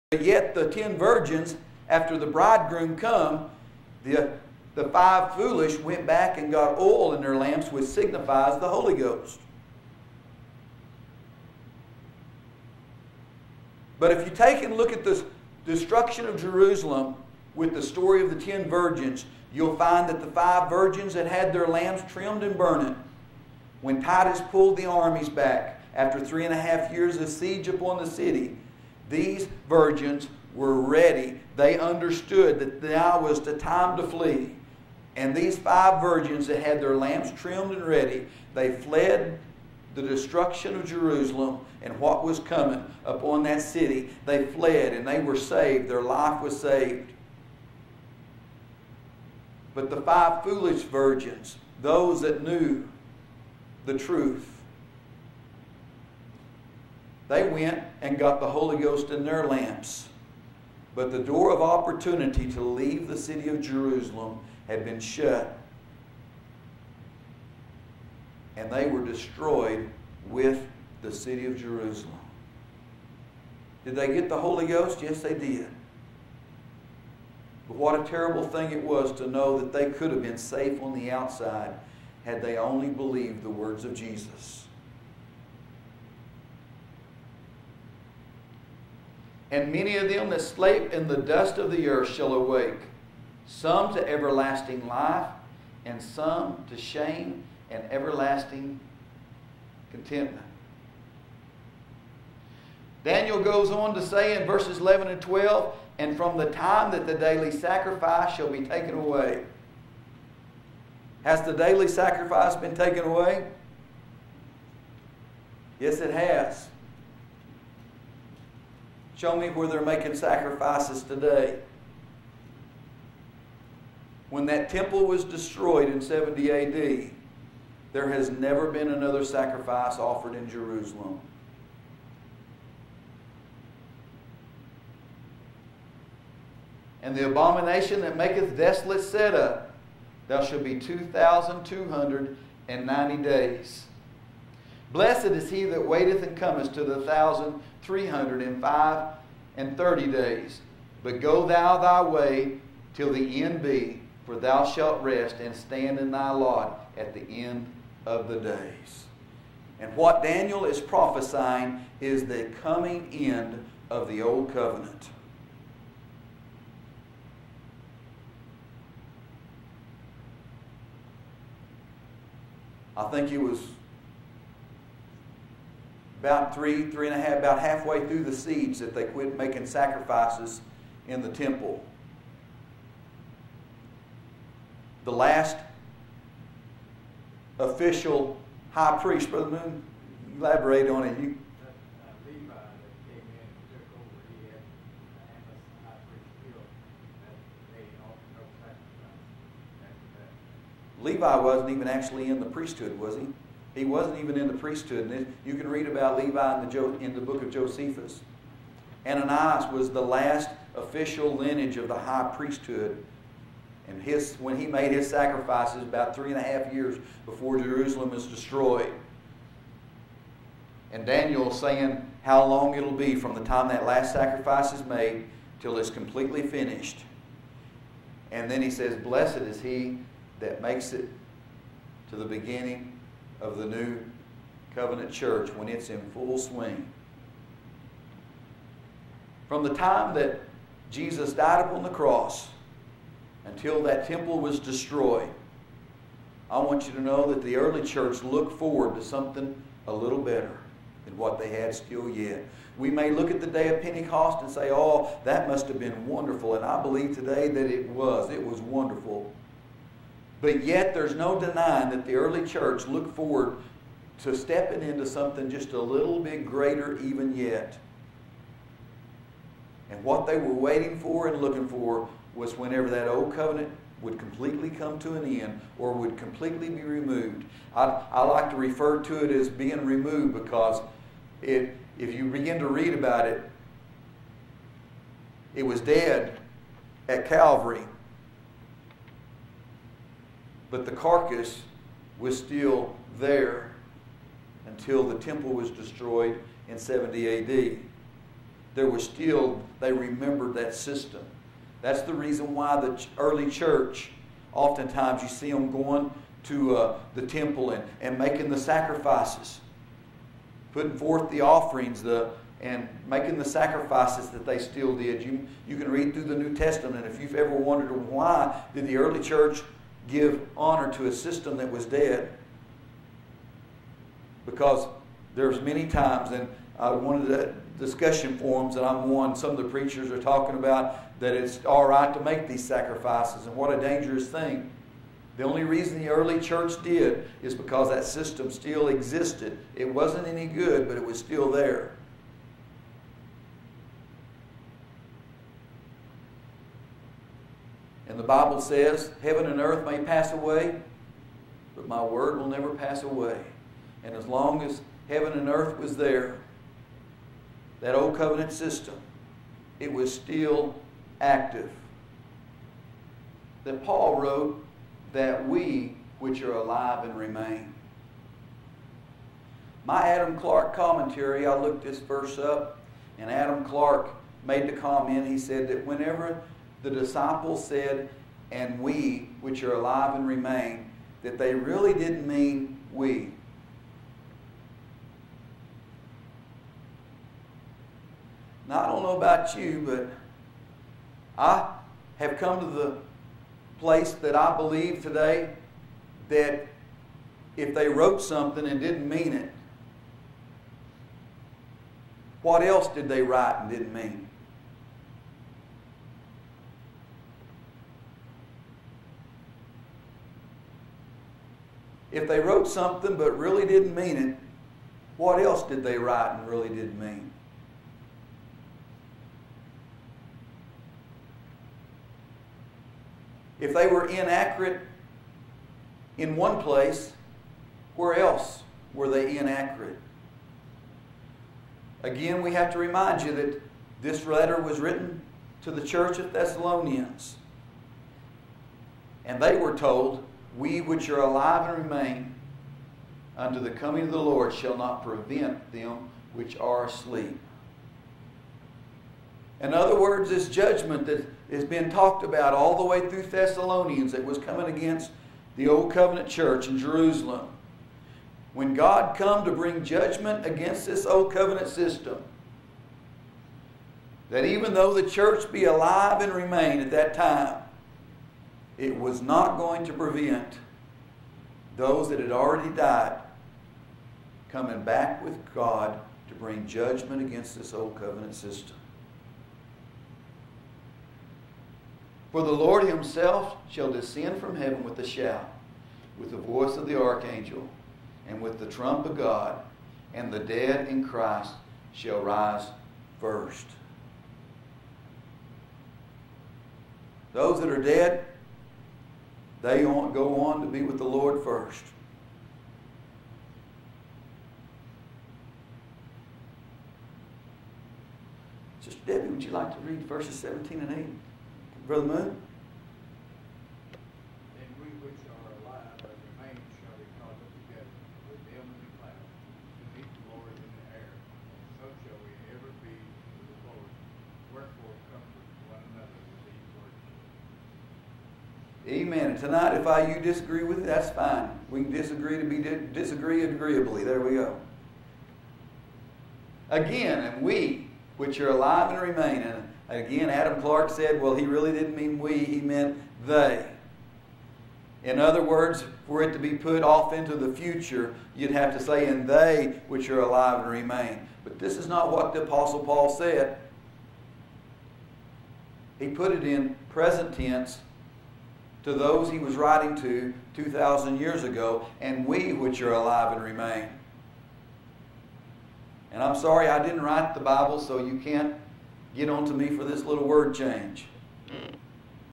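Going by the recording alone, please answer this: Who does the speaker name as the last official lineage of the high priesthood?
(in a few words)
Ananias.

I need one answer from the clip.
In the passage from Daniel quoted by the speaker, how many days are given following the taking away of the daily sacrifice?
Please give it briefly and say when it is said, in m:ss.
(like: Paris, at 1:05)
2,290, at 2:20.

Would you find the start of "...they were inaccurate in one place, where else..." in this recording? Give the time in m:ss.
7:03.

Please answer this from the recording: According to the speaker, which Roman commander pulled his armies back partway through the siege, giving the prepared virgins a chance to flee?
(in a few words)
Titus.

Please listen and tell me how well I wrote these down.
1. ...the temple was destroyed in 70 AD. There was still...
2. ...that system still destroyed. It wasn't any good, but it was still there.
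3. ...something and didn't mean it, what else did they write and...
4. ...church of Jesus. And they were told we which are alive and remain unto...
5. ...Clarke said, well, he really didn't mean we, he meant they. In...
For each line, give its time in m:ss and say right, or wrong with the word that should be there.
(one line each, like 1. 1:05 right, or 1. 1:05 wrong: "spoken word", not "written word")
1. 4:55 right
2. 5:37 wrong: "existed", not "destroyed"
3. 6:38 right
4. 7:15 wrong: "Thessalonians", not "Jesus"
5. 9:00 right.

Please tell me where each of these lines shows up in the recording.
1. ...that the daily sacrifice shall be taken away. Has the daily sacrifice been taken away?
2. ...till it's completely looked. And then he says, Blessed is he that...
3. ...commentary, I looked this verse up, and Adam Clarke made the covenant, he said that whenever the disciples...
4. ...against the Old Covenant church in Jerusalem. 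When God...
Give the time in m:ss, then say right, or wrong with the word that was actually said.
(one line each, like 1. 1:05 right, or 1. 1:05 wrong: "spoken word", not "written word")
1. 1:46 right
2. 3:45 wrong: "finished", not "looked"
3. 6:10 wrong: "comment", not "covenant"
4. 7:34 right.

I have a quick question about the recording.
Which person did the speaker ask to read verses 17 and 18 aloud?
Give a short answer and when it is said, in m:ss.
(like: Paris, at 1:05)
Sister Debbie, at 8:28.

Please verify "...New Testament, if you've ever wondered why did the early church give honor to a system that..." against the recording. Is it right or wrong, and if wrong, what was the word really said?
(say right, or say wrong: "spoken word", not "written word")
right.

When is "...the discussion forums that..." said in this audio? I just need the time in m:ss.
5:27.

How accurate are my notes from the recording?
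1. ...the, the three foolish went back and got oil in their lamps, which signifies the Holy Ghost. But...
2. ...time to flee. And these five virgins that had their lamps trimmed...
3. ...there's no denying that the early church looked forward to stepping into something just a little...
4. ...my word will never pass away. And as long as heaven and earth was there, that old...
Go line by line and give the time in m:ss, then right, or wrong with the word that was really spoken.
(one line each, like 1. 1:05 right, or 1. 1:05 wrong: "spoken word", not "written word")
1. 0:04 wrong: "five", not "three"
2. 0:33 right
3. 4:20 right
4. 5:51 right.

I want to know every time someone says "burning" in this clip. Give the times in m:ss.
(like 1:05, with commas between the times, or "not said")
0:22.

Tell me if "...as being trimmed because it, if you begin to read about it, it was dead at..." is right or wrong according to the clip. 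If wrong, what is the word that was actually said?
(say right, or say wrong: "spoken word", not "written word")
wrong: "removed", not "trimmed".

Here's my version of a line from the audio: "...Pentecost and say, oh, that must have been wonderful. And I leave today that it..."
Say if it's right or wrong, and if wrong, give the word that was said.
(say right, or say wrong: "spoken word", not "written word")
wrong: "believe", not "leave".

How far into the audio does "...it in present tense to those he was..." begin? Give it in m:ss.
9:16.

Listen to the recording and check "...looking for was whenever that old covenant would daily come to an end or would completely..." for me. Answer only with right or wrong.
wrong.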